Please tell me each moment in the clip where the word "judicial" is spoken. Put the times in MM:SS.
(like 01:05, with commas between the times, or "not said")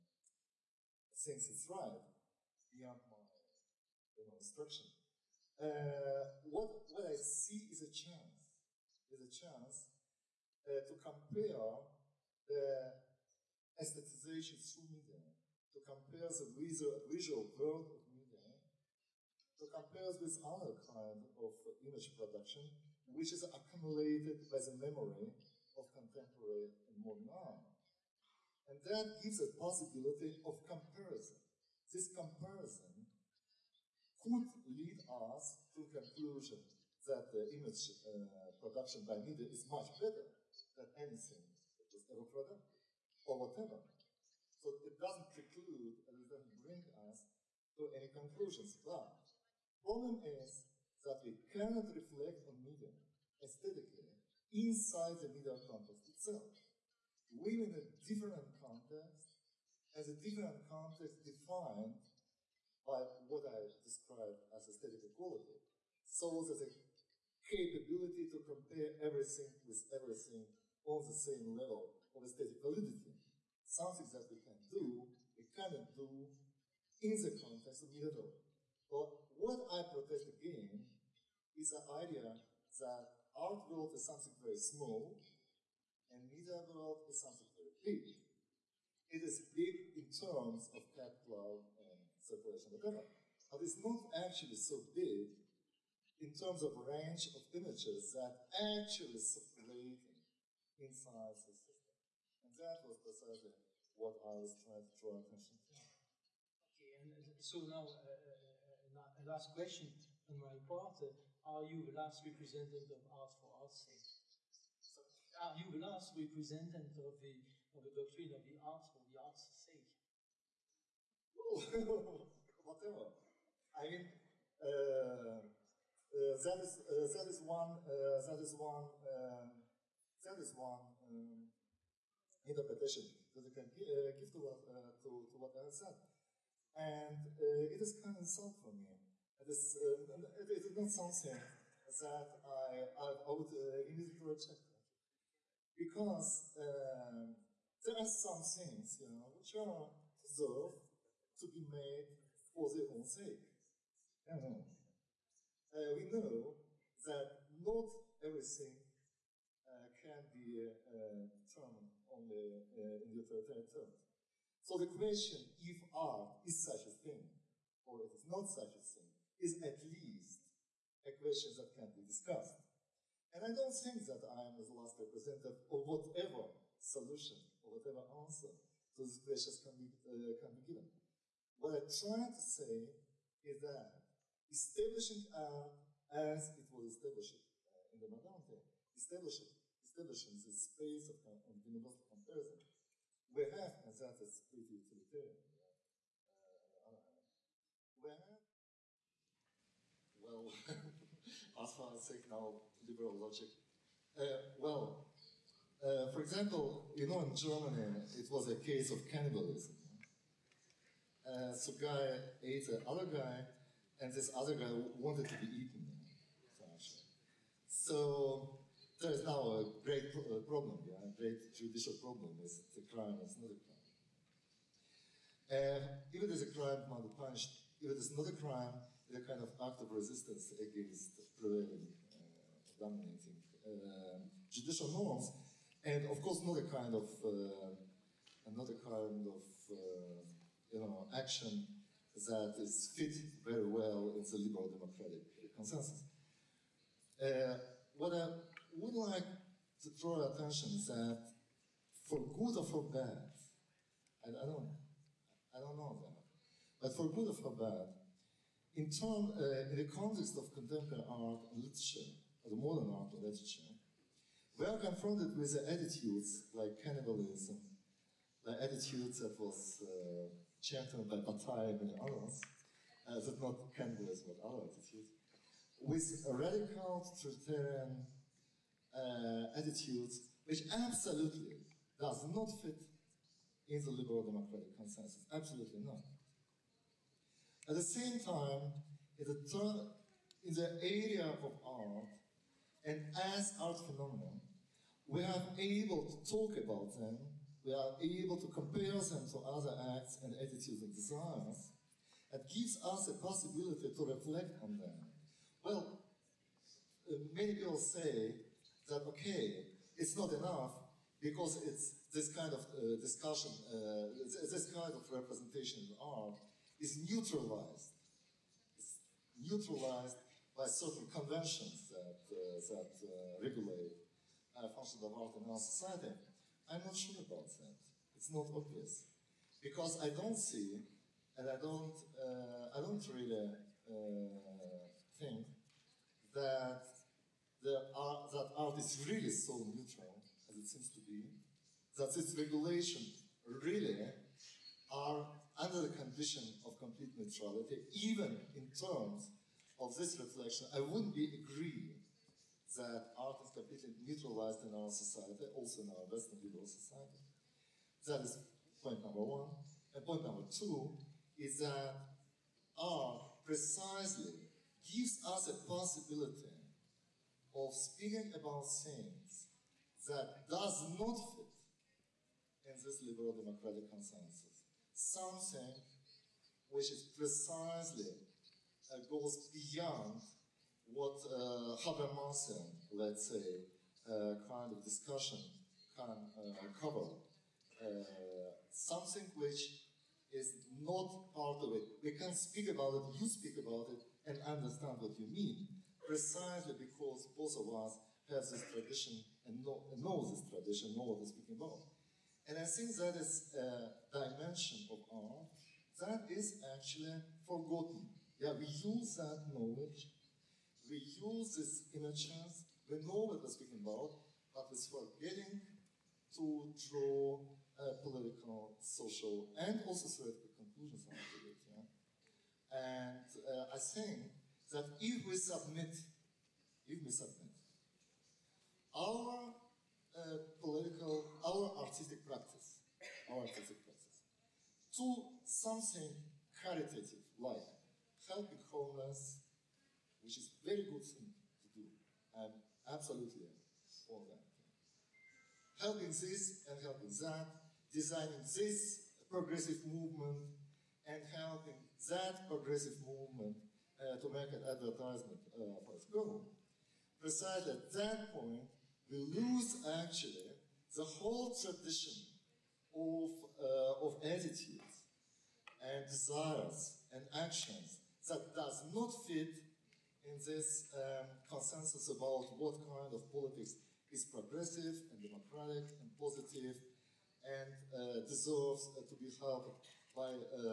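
03:41, 03:54.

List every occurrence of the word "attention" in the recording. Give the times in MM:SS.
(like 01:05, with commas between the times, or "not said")
01:45, 04:10.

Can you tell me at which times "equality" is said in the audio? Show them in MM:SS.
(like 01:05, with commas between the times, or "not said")
01:05.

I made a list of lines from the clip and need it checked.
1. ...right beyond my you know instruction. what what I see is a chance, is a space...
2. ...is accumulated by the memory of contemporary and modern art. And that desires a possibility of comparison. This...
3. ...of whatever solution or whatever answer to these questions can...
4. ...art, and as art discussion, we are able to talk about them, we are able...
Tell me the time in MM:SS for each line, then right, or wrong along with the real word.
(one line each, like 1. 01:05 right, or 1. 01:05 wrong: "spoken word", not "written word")
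1. 00:01 wrong: "chance", not "space"
2. 00:23 wrong: "gives", not "desires"
3. 02:55 right
4. 04:51 wrong: "phenomenon", not "discussion".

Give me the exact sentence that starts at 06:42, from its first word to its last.
And I think that is a dimension of art that is actually forgotten.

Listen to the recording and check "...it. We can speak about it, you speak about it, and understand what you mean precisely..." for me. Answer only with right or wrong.
right.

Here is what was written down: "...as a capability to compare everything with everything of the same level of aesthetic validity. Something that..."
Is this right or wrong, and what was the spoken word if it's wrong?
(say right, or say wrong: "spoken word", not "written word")
right.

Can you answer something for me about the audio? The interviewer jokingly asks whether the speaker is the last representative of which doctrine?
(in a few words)
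Art for art's sake.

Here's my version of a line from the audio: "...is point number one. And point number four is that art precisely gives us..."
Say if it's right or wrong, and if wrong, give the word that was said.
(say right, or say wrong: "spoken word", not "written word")
wrong: "two", not "four".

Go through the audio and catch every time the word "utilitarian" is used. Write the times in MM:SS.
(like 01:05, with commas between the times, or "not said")
03:14.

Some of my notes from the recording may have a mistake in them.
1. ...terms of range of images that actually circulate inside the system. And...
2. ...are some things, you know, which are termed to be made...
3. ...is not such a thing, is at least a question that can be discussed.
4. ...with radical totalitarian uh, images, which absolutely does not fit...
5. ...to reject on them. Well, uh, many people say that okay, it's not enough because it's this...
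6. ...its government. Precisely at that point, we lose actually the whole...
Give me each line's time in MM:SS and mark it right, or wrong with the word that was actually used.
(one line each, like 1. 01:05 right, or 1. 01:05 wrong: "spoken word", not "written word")
1. 01:36 right
2. 02:27 wrong: "deserved", not "termed"
3. 02:48 right
4. 04:35 wrong: "attitudes", not "images"
5. 05:03 wrong: "reflect", not "reject"
6. 07:35 right.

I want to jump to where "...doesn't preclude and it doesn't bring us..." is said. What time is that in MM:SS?
00:44.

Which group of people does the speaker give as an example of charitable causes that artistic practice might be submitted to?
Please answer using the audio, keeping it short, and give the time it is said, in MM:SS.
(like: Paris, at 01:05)
Homeless, at 07:18.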